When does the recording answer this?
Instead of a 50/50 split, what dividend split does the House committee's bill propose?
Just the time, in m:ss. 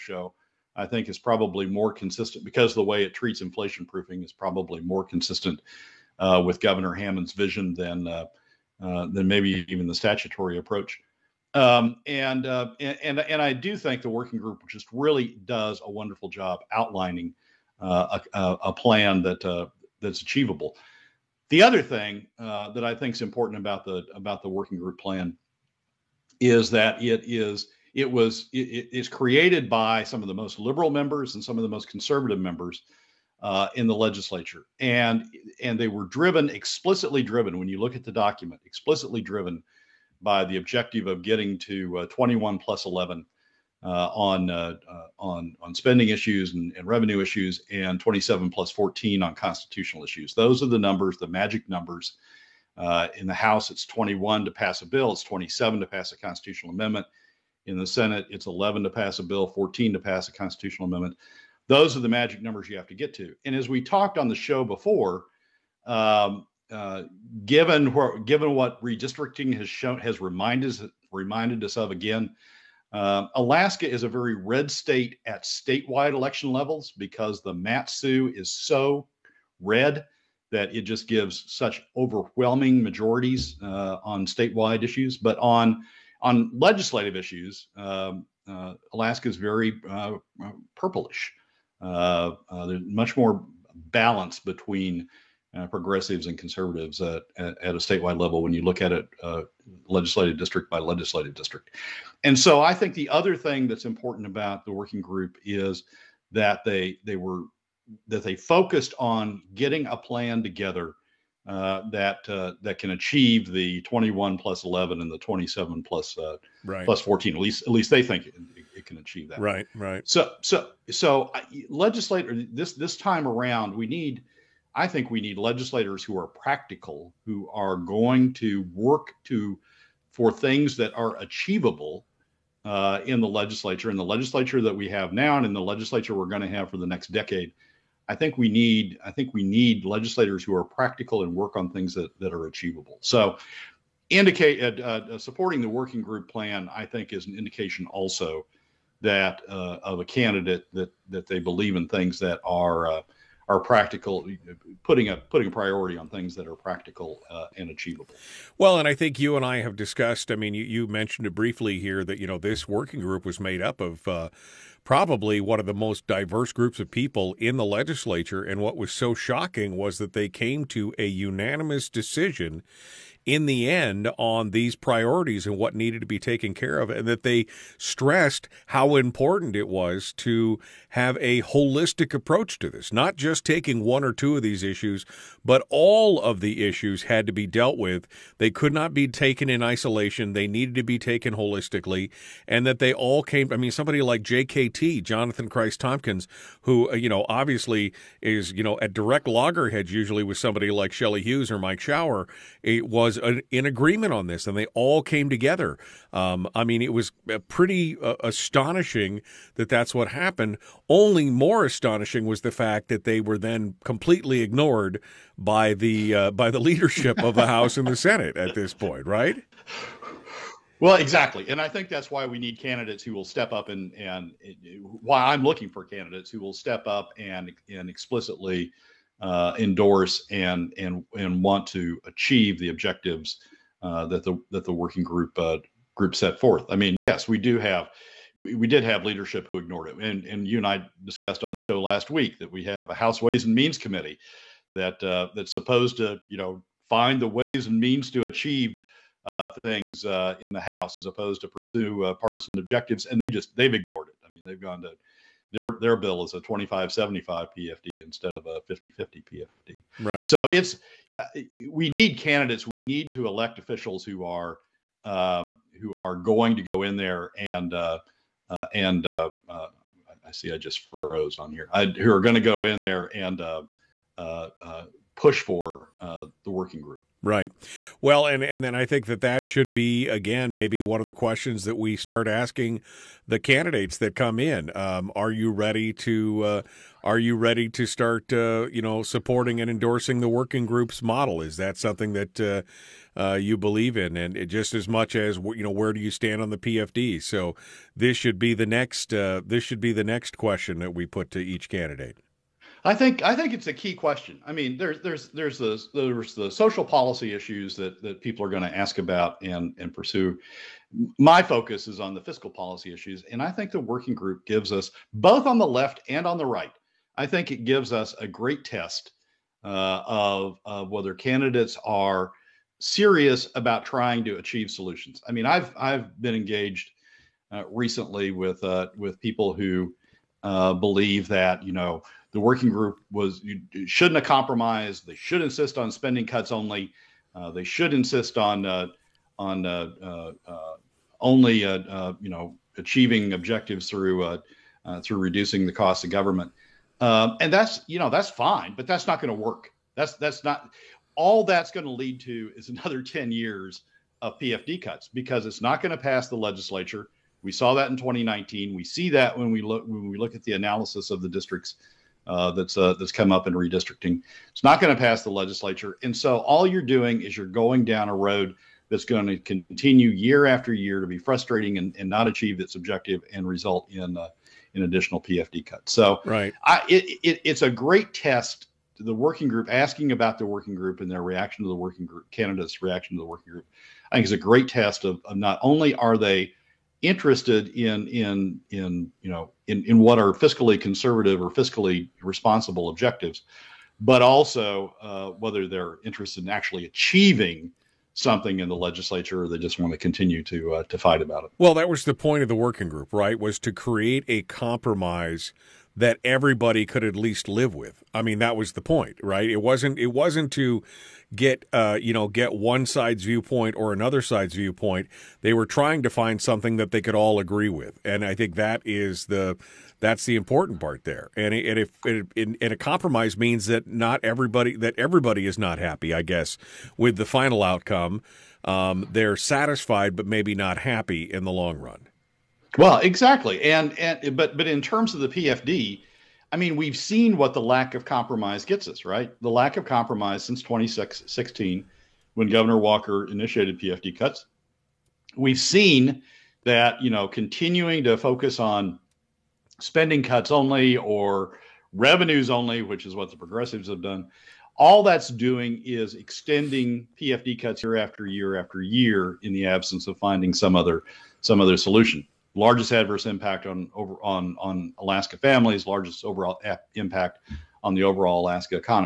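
4:16.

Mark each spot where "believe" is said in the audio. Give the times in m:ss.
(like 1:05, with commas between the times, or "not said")
2:31, 4:53, 5:30.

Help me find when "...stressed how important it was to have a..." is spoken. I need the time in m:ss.
2:57.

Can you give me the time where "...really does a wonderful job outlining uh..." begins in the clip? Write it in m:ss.
0:14.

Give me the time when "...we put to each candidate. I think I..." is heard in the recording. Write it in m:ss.
5:00.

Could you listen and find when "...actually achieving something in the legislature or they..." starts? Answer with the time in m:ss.
6:36.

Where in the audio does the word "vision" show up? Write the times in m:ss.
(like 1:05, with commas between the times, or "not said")
0:07.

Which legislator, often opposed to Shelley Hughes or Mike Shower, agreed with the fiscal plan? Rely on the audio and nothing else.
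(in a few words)
Jonathan Kreiss-Tomkins.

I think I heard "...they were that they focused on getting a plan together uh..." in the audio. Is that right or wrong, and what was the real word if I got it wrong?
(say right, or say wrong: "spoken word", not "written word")
right.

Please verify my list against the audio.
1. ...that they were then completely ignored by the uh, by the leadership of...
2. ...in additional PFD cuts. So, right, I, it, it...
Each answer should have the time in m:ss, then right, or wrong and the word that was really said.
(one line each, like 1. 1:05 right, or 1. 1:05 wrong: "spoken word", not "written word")
1. 3:32 right
2. 6:14 right.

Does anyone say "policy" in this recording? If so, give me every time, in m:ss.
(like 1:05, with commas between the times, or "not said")
5:06, 5:12.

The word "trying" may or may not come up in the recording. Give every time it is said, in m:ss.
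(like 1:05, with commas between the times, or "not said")
5:23, 6:55.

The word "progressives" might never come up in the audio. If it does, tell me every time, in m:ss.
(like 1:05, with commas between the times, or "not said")
1:35, 7:33.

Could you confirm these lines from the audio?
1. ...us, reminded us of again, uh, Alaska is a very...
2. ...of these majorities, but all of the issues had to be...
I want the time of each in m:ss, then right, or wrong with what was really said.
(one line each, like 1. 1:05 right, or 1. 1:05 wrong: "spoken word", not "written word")
1. 1:10 right
2. 3:04 wrong: "issues", not "majorities".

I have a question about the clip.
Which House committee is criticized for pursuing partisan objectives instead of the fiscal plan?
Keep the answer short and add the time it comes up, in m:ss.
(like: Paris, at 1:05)
Ways and Means Committee, at 4:03.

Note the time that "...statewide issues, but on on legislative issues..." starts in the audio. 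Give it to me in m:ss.
1:24.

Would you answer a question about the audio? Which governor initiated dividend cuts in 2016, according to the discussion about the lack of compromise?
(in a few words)
Governor Walker.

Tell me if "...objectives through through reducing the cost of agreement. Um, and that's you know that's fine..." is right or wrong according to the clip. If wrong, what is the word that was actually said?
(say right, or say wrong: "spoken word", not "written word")
wrong: "government", not "agreement".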